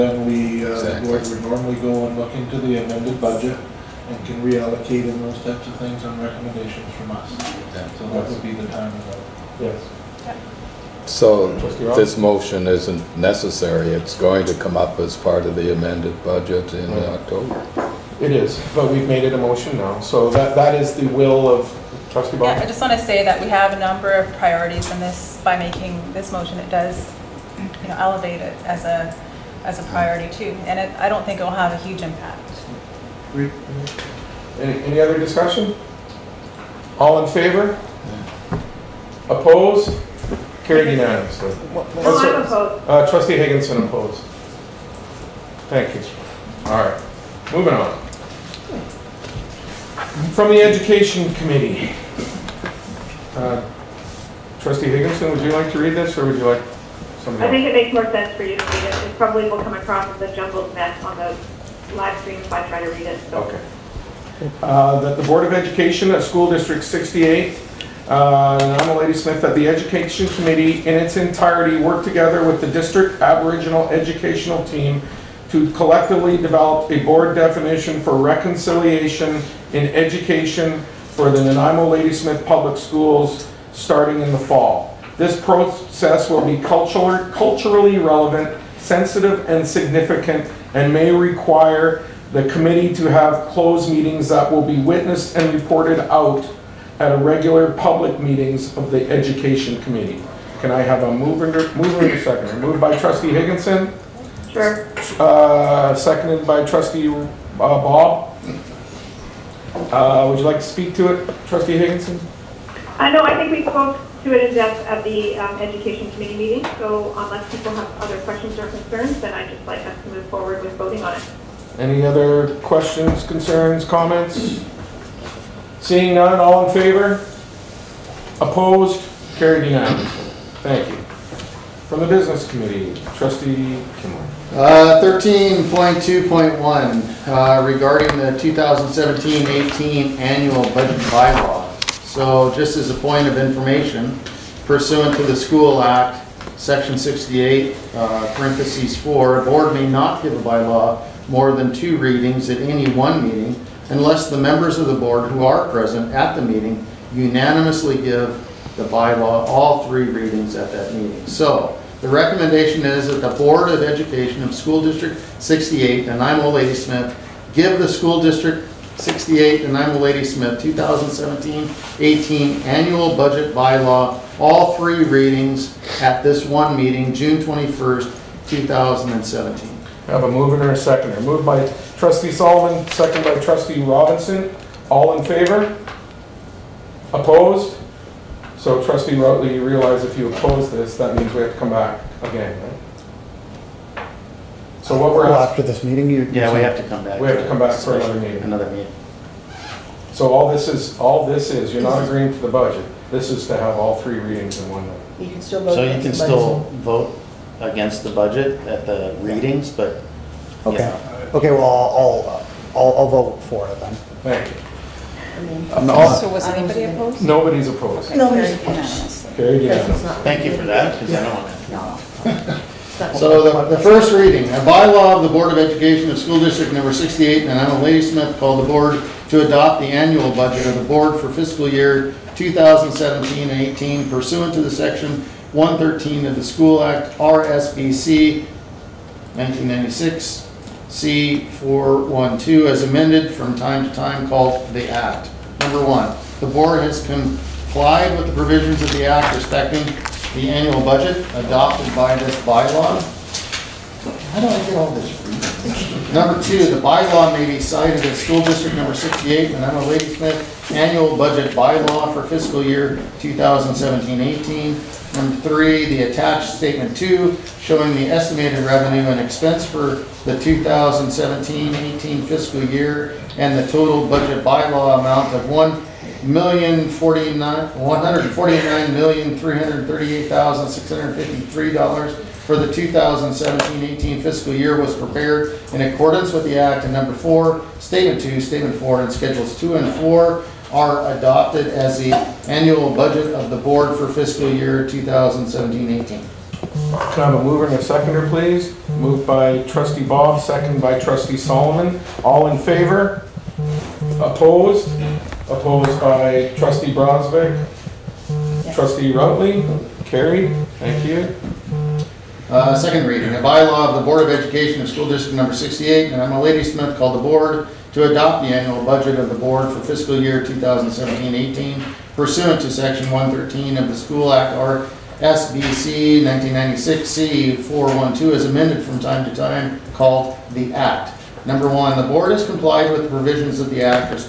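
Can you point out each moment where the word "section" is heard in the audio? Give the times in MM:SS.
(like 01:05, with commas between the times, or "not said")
02:26, 03:54, 05:22.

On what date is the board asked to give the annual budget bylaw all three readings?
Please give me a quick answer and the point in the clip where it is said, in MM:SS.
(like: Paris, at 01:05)
June 21st, 2017, at 02:57.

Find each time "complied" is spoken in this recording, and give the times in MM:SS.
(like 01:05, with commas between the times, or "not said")
04:07, 05:32.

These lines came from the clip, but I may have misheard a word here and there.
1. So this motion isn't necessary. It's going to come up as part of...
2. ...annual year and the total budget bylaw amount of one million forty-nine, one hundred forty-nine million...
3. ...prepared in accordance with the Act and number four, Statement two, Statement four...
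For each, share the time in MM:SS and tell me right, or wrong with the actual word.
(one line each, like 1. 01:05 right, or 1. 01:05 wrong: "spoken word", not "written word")
1. 00:11 right
2. 04:32 wrong: "fiscal", not "annual"
3. 04:44 right.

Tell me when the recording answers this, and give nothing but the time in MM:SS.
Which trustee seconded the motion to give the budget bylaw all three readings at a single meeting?
03:03.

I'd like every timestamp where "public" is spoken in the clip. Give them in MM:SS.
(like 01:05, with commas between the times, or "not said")
01:22, 01:37.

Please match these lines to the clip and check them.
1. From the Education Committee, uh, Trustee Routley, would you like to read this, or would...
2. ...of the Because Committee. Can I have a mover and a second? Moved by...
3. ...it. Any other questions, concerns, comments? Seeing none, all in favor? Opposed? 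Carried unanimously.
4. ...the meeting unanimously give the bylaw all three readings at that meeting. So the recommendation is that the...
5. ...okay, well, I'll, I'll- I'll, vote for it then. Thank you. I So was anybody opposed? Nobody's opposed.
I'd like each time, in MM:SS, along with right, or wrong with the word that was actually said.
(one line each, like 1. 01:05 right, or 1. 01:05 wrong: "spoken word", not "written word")
1. 00:50 wrong: "Higginson", not "Routley"
2. 01:38 wrong: "Education", not "Because"
3. 02:01 right
4. 02:36 right
5. 03:31 right.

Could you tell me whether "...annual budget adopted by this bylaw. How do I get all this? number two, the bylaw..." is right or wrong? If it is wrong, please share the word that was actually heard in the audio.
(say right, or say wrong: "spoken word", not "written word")
right.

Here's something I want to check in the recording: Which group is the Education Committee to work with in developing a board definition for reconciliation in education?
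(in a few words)
District Aboriginal Educational Team.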